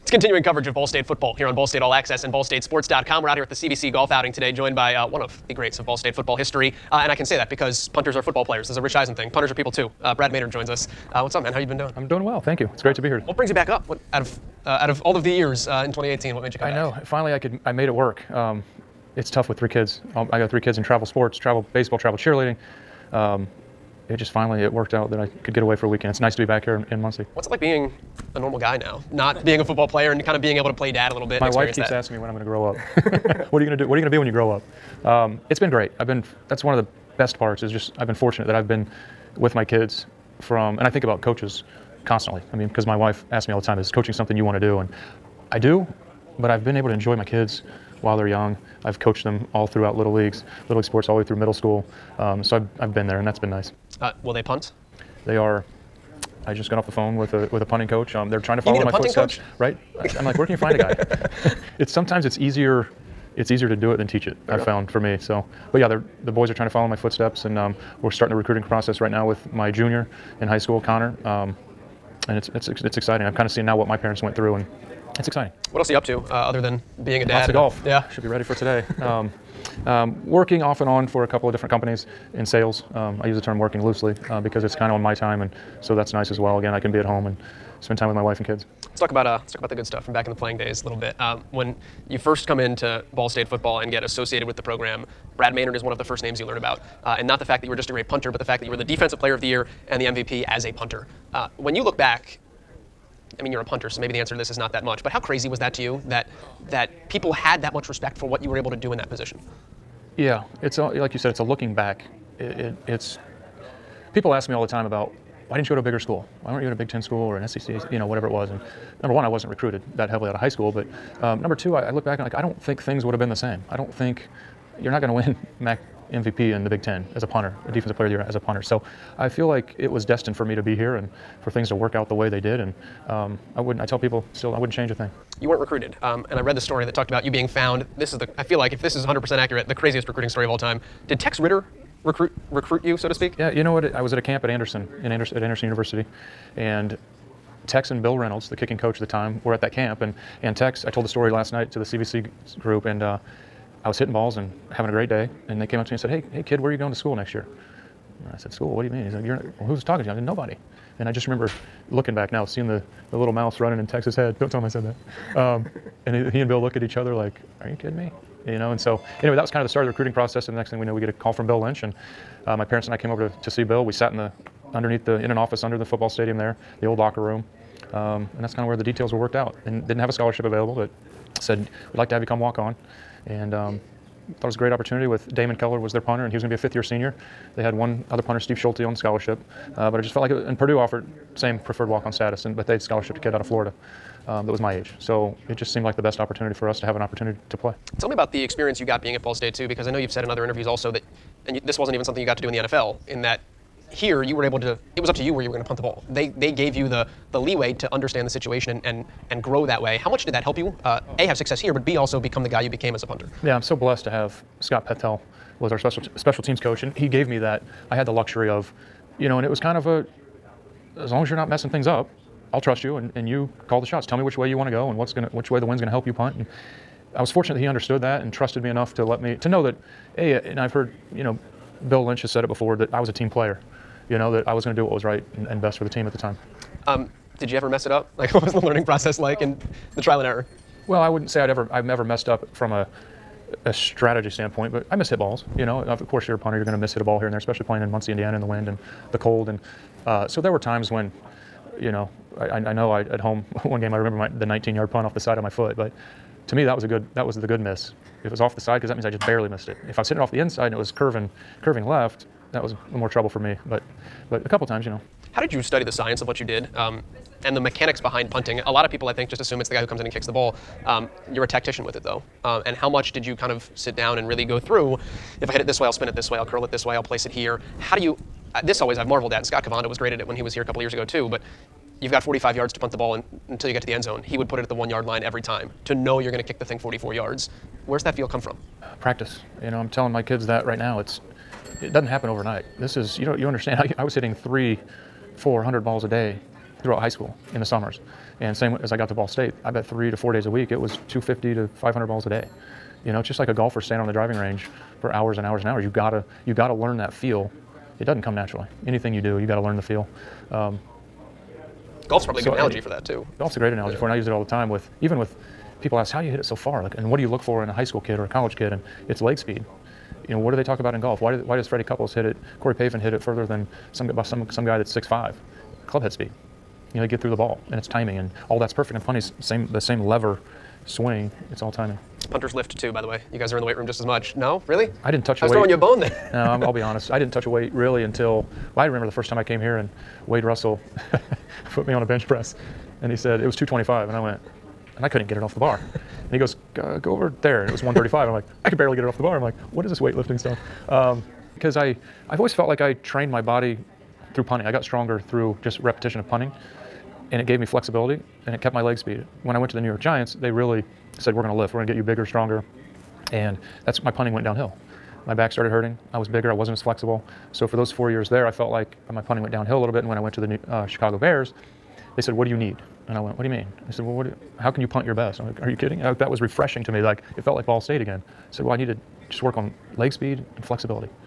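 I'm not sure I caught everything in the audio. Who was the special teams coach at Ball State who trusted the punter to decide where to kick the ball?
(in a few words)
Scott Petel.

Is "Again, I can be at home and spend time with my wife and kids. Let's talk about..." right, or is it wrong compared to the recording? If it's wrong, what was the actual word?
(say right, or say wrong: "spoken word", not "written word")
right.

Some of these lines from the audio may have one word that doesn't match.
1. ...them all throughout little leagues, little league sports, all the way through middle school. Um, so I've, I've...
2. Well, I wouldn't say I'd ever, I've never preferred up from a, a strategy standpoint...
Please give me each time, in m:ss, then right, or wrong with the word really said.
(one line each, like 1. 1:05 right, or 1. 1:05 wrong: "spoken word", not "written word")
1. 0:49 right
2. 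4:00 wrong: "messed", not "preferred".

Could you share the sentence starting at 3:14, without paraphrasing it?
So it just seemed like the best opportunity for us to have an opportunity to play.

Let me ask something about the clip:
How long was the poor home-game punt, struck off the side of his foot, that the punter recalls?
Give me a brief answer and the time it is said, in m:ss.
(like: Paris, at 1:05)
19 yards, at 4:14.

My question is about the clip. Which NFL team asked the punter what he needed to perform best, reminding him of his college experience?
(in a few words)
Chicago Bears.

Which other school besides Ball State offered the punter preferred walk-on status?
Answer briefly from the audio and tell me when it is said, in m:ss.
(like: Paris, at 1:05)
Purdue, at 3:10.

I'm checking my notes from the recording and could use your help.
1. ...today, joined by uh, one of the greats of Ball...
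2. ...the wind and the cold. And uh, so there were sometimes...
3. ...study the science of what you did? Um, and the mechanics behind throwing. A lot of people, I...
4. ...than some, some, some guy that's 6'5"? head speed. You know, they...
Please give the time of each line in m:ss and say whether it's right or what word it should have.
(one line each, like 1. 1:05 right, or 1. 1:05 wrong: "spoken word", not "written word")
1. 0:04 right
2. 4:08 wrong: "times", not "sometimes"
3. 4:25 wrong: "punting", not "throwing"
4. 5:23 right.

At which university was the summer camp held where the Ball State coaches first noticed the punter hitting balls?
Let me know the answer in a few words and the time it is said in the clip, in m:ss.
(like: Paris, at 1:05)
Anderson University, at 2:25.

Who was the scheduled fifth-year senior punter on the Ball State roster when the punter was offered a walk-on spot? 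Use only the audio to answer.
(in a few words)
Damon Keller.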